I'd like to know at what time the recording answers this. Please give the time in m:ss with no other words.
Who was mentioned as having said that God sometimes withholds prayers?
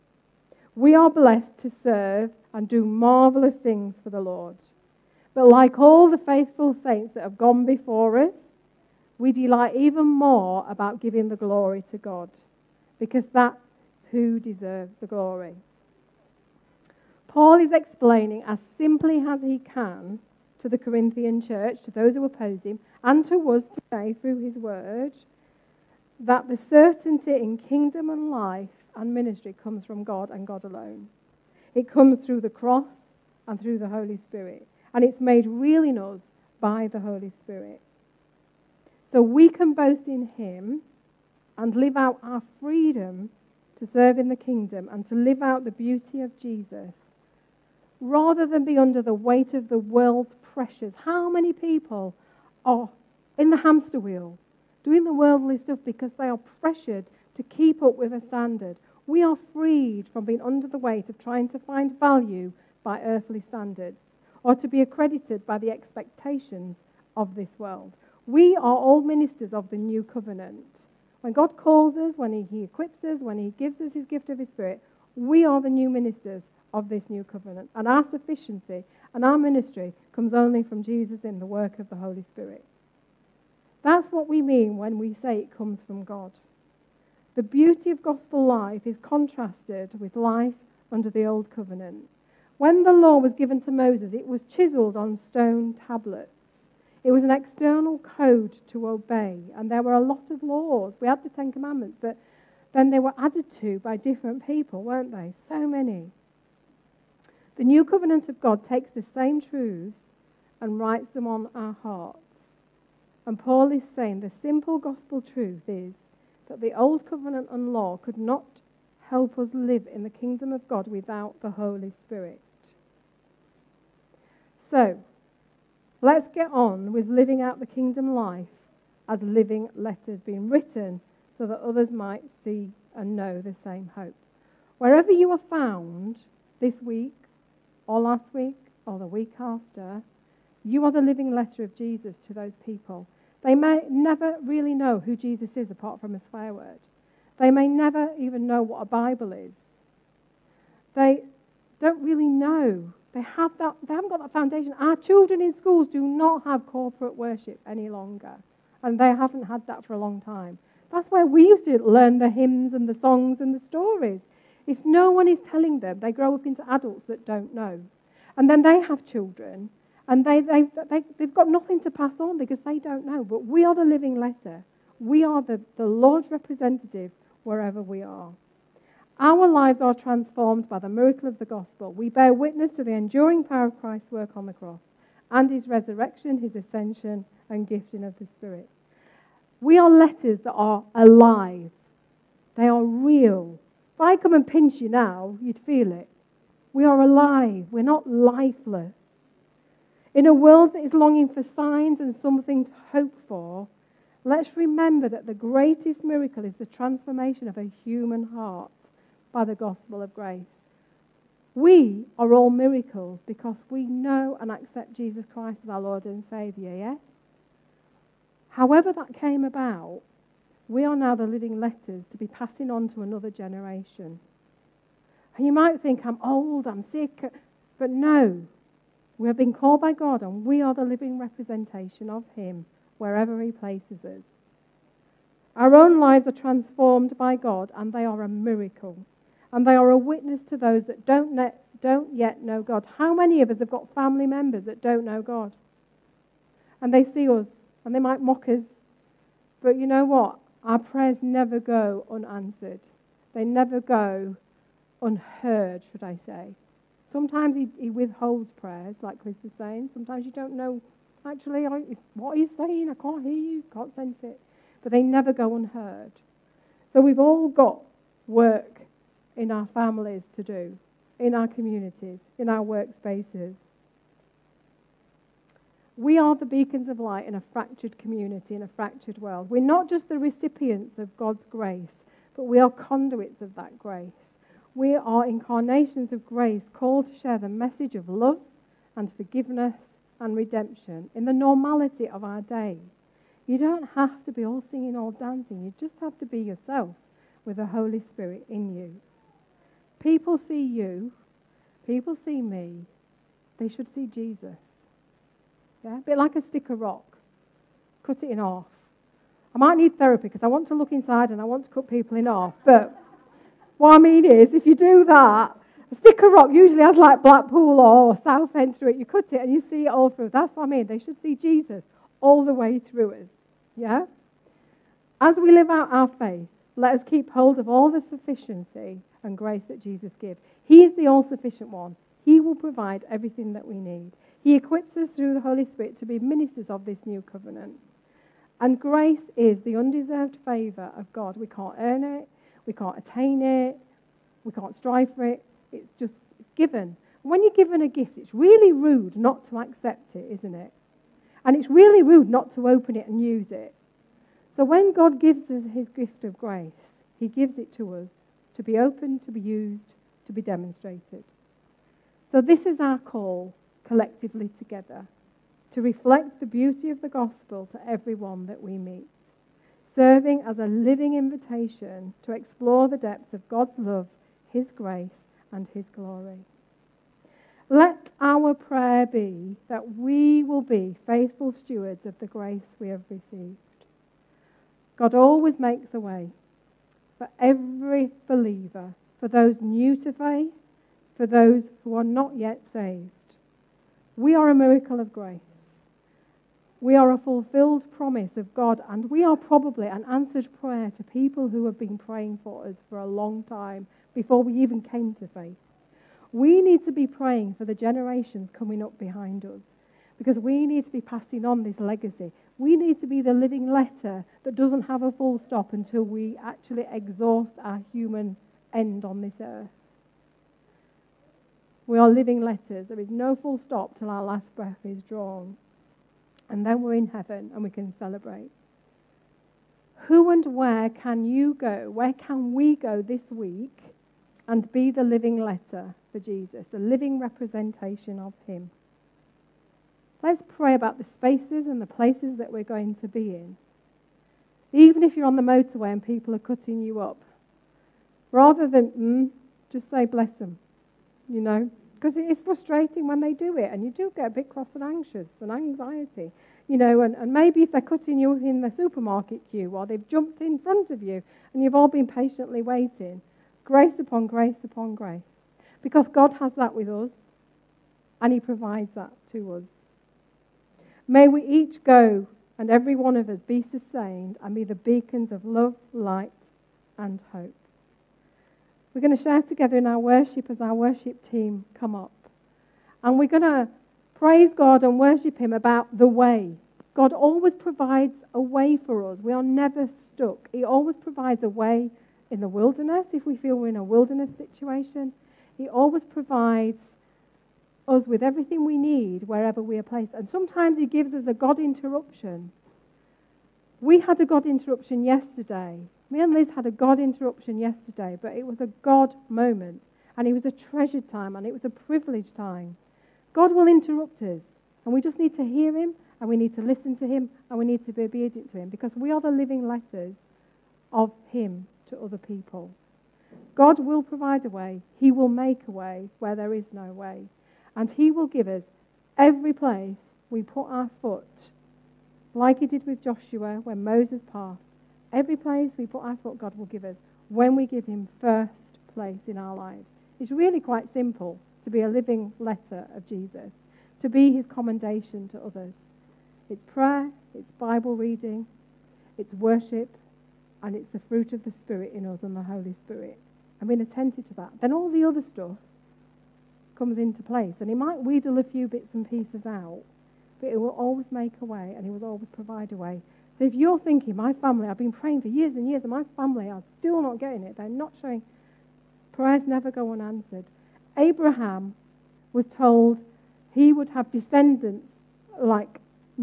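4:19.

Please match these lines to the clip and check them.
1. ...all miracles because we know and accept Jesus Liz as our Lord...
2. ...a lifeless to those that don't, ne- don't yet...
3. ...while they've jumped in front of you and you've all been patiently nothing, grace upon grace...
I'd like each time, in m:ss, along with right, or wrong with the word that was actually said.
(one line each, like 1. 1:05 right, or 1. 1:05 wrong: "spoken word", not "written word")
1. 3:32 wrong: "Christ", not "Liz"
2. 3:59 wrong: "witness", not "lifeless"
3. 7:39 wrong: "waiting", not "nothing".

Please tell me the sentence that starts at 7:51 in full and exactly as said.
May we each go and every one of us be sustained and be the beacons of love, light, and hope.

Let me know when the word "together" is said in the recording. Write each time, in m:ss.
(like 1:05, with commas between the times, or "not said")
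6:04, 7:59.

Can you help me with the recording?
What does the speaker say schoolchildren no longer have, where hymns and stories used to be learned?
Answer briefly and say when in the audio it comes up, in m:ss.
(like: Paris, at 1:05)
Corporate worship, at 2:36.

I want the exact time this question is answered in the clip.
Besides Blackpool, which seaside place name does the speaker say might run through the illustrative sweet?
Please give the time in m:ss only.
5:18.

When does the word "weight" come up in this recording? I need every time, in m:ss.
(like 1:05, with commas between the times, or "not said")
0:49, 1:00.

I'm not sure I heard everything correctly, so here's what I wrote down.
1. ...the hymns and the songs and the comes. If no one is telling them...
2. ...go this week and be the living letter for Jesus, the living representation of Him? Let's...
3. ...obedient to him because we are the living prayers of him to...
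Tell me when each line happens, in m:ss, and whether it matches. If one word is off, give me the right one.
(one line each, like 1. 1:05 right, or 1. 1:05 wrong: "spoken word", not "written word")
1. 2:42 wrong: "stories", not "comes"
2. 7:12 right
3. 8:38 wrong: "letters", not "prayers".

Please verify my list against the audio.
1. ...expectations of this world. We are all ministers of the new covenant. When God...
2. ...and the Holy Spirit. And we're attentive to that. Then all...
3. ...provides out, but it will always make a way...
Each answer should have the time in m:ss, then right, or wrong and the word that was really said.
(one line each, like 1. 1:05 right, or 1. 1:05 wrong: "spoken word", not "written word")
1. 1:05 right
2. 9:12 right
3. 9:19 wrong: "pieces", not "provides".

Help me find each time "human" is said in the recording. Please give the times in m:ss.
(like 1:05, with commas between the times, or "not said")
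3:27, 6:57.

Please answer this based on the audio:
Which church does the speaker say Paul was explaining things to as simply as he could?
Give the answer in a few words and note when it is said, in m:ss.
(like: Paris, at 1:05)
Corinthian church, at 0:20.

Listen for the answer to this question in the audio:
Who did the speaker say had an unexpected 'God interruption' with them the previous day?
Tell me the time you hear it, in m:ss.
8:26.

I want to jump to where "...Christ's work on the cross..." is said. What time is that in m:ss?
3:03.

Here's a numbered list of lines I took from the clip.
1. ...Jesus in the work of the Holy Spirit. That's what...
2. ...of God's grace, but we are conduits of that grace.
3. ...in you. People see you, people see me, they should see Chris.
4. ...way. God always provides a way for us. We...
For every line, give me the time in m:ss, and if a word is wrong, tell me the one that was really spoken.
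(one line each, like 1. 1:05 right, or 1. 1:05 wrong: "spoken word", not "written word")
1. 1:20 right
2. 4:40 right
3. 4:58 wrong: "Jesus", not "Chris"
4. 8:06 right.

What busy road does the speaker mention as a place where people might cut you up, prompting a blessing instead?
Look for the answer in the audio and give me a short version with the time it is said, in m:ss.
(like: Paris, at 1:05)
The motorway, at 7:25.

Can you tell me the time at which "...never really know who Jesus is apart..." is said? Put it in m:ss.
2:23.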